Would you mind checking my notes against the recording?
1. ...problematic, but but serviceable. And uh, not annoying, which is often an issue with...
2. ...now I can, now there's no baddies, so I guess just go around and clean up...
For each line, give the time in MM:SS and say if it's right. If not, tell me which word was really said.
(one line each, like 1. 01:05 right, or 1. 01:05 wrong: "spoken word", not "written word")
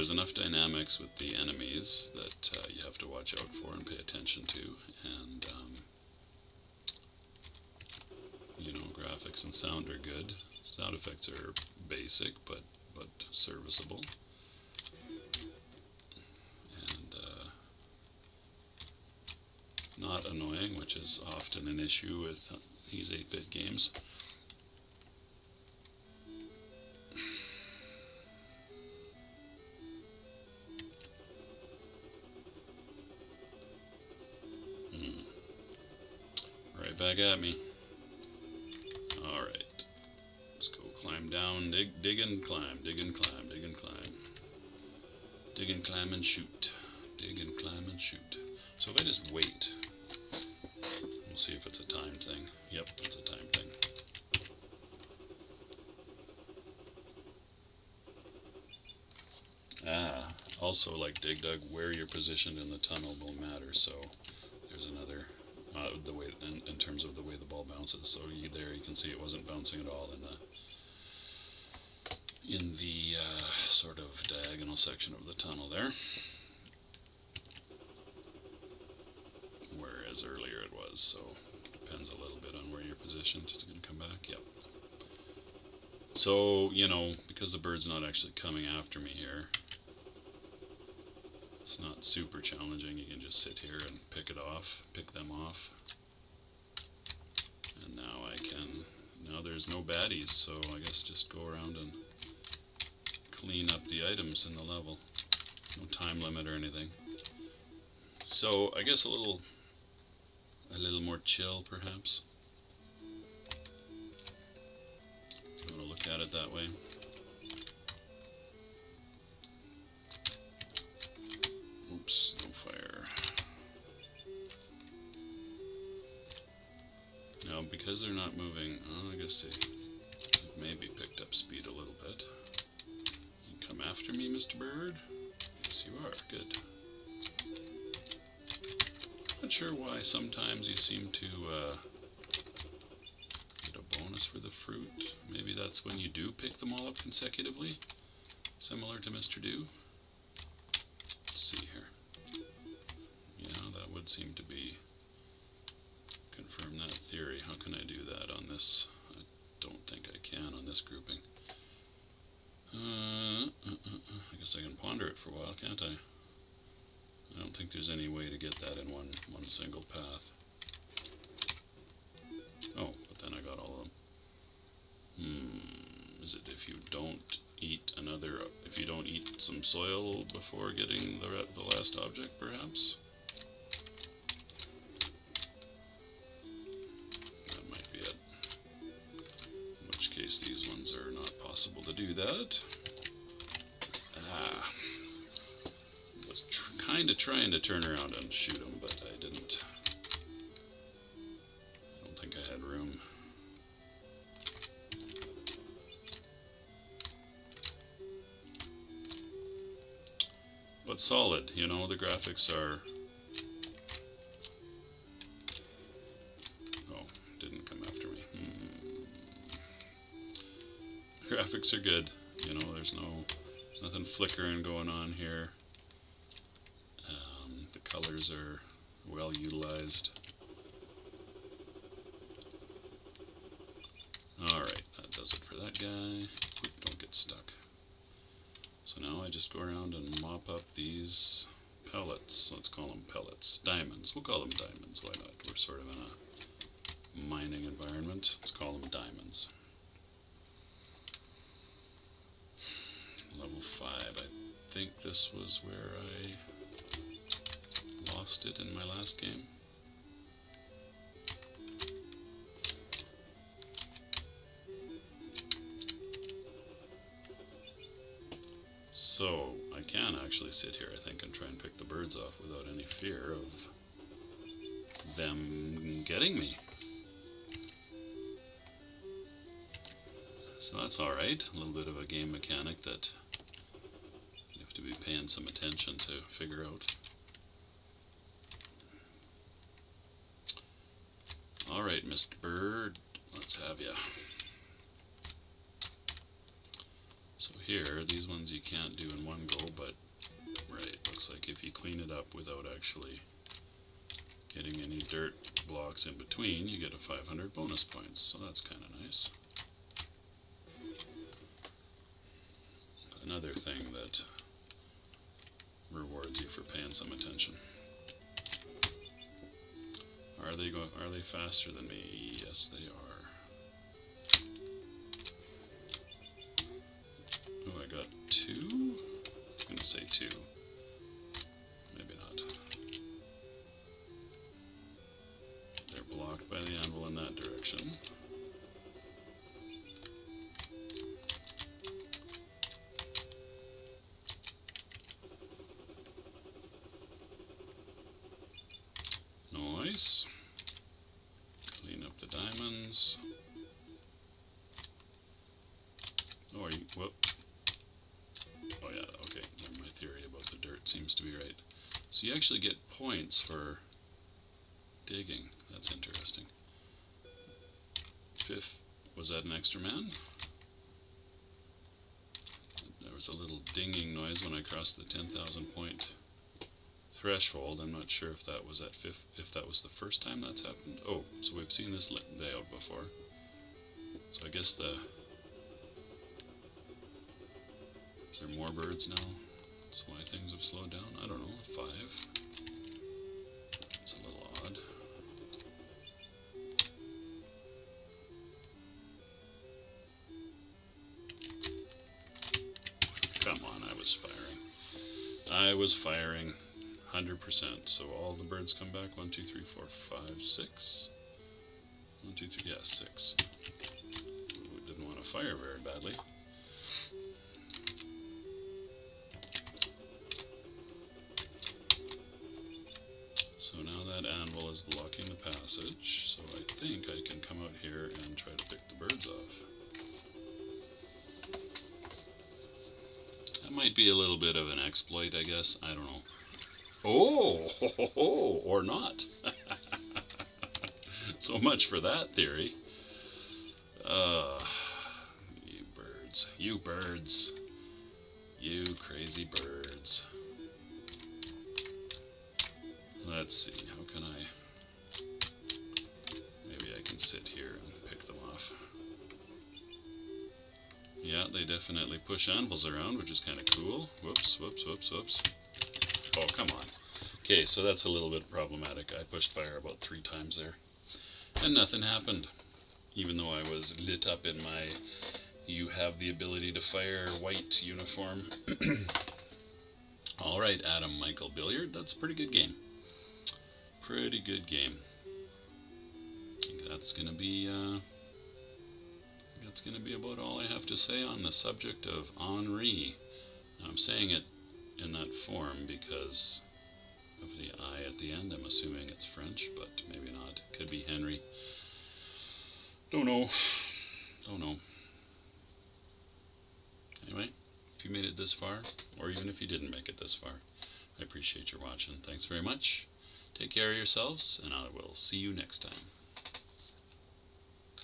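1. 00:11 wrong: "basic", not "problematic"
2. 01:37 right.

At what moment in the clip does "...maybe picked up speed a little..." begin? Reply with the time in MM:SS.
02:10.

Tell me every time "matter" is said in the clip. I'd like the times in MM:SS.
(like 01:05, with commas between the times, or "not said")
01:03.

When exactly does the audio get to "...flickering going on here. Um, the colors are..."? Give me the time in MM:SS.
03:44.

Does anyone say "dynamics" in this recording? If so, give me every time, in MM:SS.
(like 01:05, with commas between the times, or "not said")
00:00.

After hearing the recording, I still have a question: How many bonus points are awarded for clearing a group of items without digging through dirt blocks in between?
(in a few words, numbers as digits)
500.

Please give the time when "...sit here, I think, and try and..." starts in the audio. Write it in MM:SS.
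04:30.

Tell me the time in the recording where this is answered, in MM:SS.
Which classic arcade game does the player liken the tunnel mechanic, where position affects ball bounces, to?
01:01.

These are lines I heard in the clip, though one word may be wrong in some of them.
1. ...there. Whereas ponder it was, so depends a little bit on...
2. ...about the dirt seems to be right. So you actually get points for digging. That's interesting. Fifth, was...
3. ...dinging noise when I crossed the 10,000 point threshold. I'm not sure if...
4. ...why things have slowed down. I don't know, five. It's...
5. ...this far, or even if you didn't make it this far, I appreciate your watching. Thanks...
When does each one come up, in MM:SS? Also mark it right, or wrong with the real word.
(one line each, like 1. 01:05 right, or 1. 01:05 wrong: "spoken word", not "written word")
1. 01:15 wrong: "earlier", not "ponder"
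2. 06:00 right
3. 06:13 right
4. 06:30 right
5. 08:28 right.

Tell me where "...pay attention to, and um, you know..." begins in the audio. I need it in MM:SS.
00:03.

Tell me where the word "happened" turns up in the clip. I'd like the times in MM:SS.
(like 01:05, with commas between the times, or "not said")
06:20, 07:52.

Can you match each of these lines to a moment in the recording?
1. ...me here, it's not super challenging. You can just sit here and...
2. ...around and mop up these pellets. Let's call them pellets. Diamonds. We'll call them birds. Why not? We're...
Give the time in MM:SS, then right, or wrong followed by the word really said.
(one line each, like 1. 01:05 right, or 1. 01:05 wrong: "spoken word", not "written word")
1. 01:28 right
2. 03:59 wrong: "diamonds", not "birds".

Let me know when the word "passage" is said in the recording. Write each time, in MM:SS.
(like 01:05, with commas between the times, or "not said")
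07:05.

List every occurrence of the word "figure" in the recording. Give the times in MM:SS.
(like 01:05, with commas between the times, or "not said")
04:46.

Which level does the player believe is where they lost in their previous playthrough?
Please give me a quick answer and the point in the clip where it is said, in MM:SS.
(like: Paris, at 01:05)
Level 5, at 04:13.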